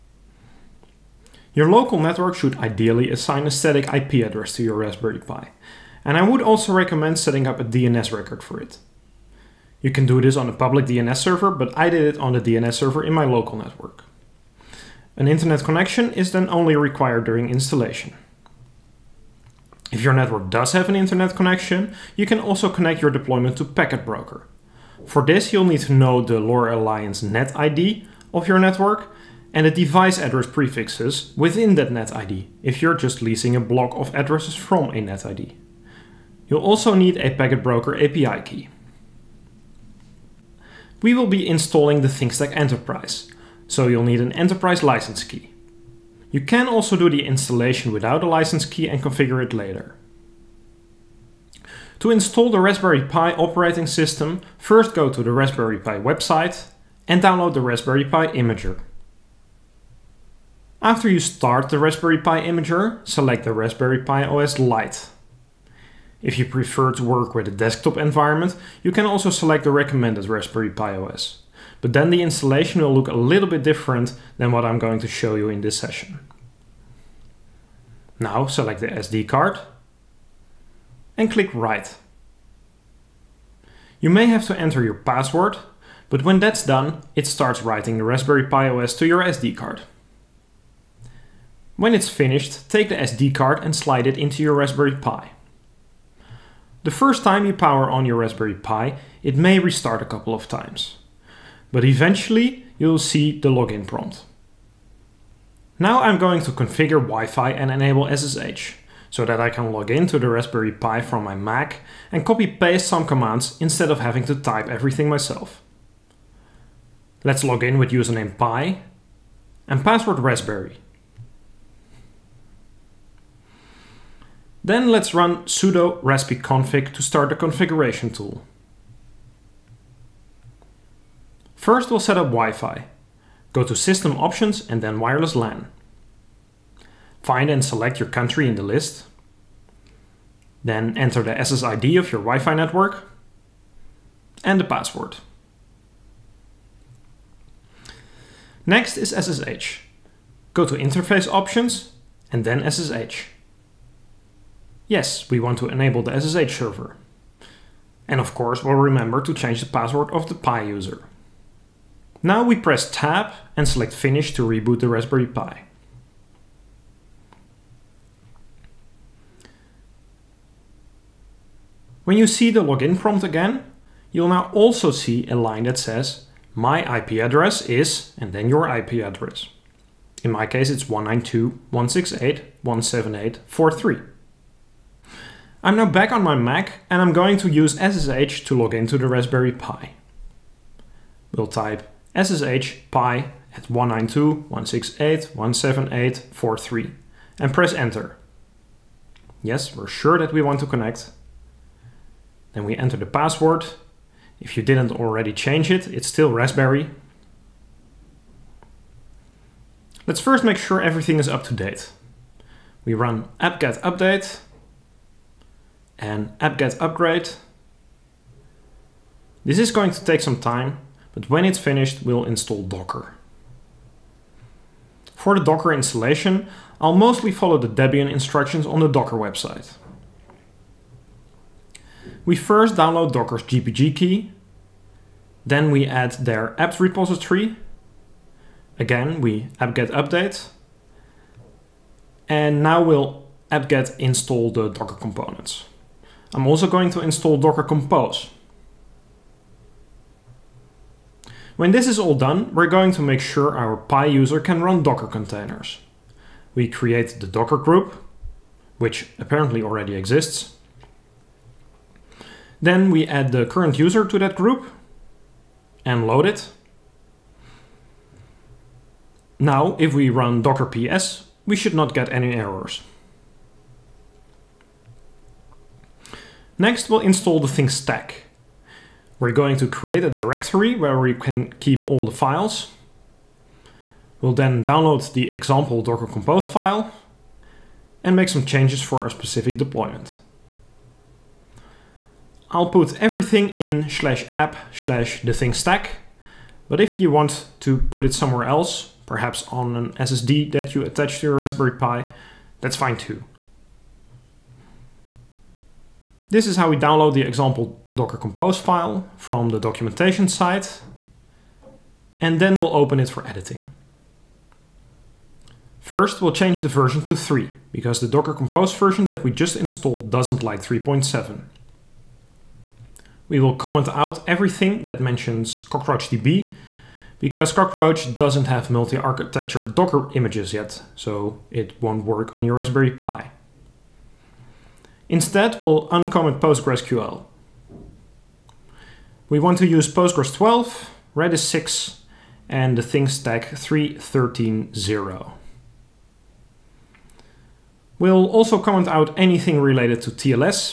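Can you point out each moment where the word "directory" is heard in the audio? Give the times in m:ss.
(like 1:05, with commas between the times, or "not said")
4:40.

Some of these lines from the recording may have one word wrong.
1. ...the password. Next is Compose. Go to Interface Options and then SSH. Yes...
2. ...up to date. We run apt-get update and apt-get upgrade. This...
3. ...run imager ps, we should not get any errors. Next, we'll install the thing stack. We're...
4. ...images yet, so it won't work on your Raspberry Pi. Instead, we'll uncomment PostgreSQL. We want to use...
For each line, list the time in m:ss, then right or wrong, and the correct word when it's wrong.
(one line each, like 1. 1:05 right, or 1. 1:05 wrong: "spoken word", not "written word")
1. 2:24 wrong: "SSH", not "Compose"
2. 3:31 right
3. 4:30 wrong: "docker", not "imager"
4. 5:30 right.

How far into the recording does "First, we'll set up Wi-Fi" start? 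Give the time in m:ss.
2:11.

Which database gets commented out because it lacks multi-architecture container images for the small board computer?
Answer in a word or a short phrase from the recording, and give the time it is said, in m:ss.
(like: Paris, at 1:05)
CockroachDB, at 5:25.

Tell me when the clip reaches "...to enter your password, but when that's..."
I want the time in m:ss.
1:24.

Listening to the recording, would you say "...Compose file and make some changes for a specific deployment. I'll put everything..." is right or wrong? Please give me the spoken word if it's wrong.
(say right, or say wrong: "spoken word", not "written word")
right.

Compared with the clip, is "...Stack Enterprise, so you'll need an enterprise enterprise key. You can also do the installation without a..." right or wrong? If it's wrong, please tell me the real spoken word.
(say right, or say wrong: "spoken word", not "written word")
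wrong: "license", not "enterprise".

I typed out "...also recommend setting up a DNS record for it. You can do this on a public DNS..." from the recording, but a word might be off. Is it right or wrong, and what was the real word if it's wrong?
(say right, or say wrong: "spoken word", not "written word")
right.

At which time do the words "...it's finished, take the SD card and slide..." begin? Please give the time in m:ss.
1:31.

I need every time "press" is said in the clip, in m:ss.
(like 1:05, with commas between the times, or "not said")
2:42, 3:17.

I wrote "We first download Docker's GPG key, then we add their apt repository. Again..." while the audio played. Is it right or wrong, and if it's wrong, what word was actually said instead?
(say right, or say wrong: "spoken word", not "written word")
right.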